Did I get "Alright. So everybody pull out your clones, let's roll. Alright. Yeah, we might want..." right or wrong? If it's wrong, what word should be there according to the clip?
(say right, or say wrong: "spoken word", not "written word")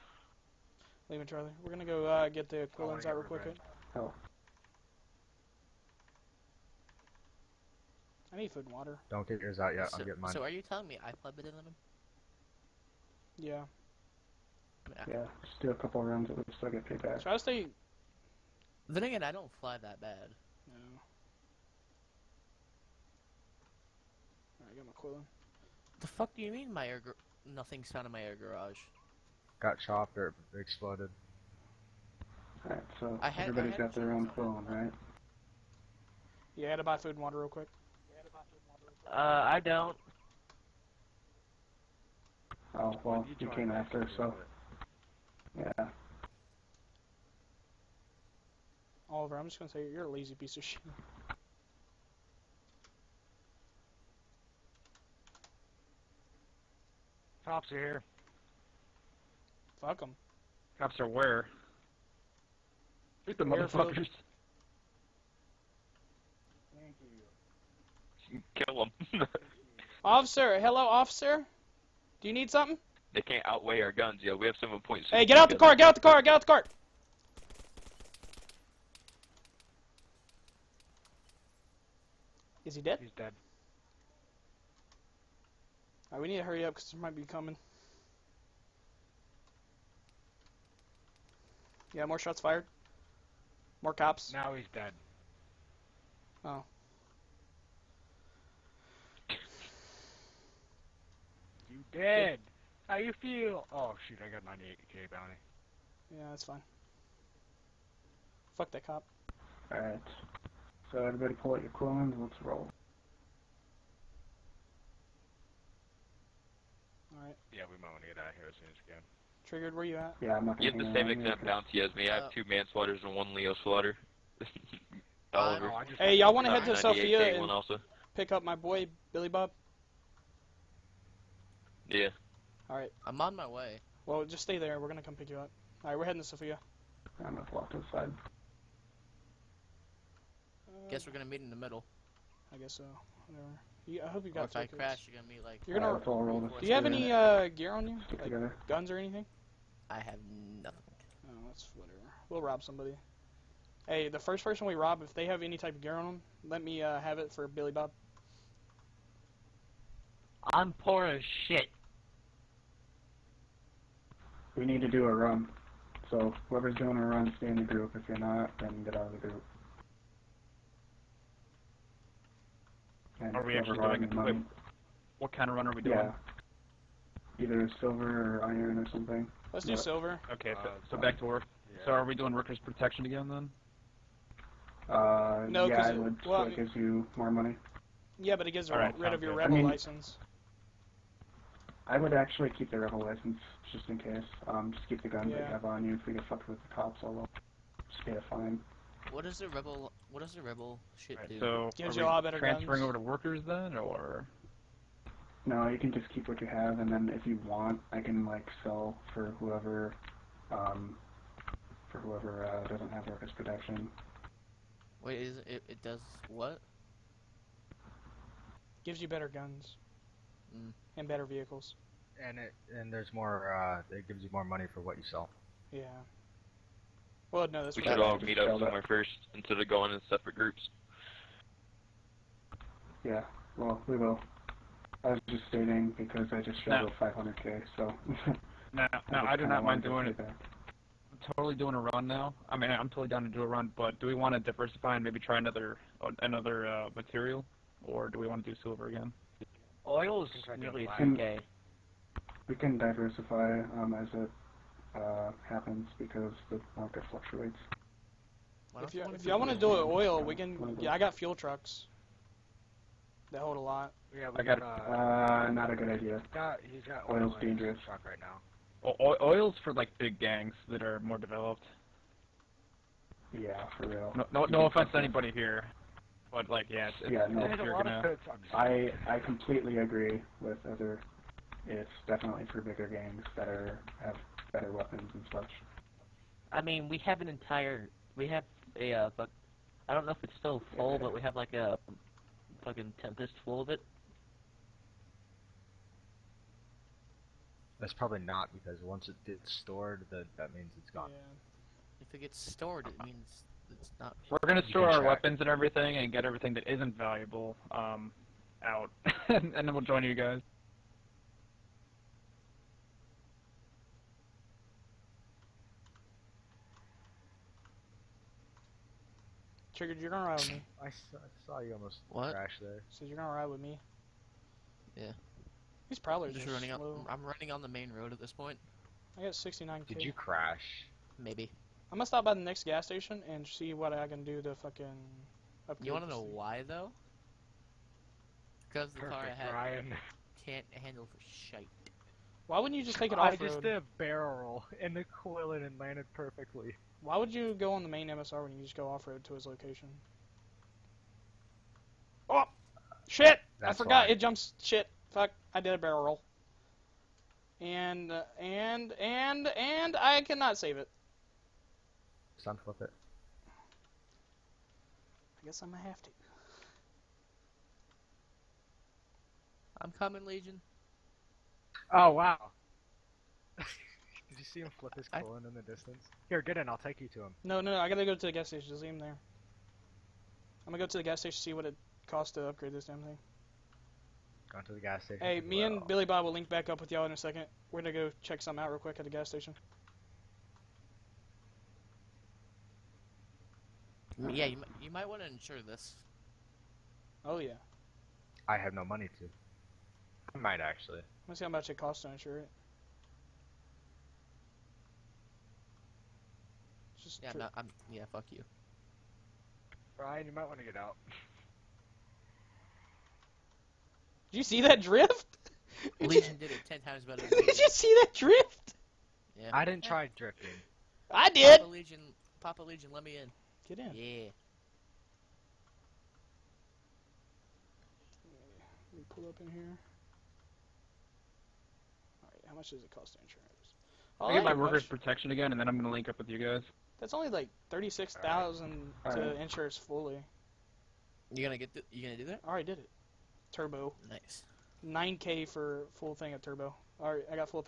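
right.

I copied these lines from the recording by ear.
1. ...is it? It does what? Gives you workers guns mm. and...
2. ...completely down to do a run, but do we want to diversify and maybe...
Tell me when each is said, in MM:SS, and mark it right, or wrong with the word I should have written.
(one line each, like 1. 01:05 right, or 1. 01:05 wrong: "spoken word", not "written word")
1. 03:35 wrong: "better", not "workers"
2. 04:02 wrong: "totally", not "completely".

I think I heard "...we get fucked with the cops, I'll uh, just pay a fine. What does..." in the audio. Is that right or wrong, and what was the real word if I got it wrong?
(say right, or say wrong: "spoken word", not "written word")
right.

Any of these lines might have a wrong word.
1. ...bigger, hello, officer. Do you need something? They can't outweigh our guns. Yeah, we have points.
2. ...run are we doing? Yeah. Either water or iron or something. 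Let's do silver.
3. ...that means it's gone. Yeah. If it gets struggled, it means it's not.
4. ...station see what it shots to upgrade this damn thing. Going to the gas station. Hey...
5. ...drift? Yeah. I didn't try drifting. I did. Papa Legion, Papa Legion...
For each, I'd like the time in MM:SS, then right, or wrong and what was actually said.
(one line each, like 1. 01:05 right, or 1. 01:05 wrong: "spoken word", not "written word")
1. 01:10 wrong: "officer", not "bigger"
2. 02:55 wrong: "silver", not "water"
3. 05:00 wrong: "stored", not "struggled"
4. 06:21 wrong: "costs", not "shots"
5. 06:58 right.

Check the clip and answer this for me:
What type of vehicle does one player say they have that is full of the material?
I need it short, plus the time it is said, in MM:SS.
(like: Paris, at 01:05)
Tempest, at 04:53.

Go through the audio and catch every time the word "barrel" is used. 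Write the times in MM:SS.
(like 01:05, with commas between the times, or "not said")
05:43, 05:55.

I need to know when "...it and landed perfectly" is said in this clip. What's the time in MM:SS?
05:45.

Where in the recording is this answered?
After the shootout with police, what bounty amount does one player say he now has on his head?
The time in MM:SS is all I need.
01:44.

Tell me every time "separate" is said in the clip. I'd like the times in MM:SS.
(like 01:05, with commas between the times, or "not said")
03:50.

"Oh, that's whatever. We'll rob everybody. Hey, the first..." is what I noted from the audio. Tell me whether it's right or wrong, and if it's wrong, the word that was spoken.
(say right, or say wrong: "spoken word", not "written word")
wrong: "somebody", not "everybody".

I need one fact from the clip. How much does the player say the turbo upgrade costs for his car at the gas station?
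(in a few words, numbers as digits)
9K.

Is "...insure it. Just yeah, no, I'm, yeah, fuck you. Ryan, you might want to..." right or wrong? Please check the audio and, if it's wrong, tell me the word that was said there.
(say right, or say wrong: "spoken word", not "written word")
right.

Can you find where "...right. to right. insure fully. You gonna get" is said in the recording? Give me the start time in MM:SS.
07:19.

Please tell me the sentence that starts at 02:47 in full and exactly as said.
If you're not, then get out of the group.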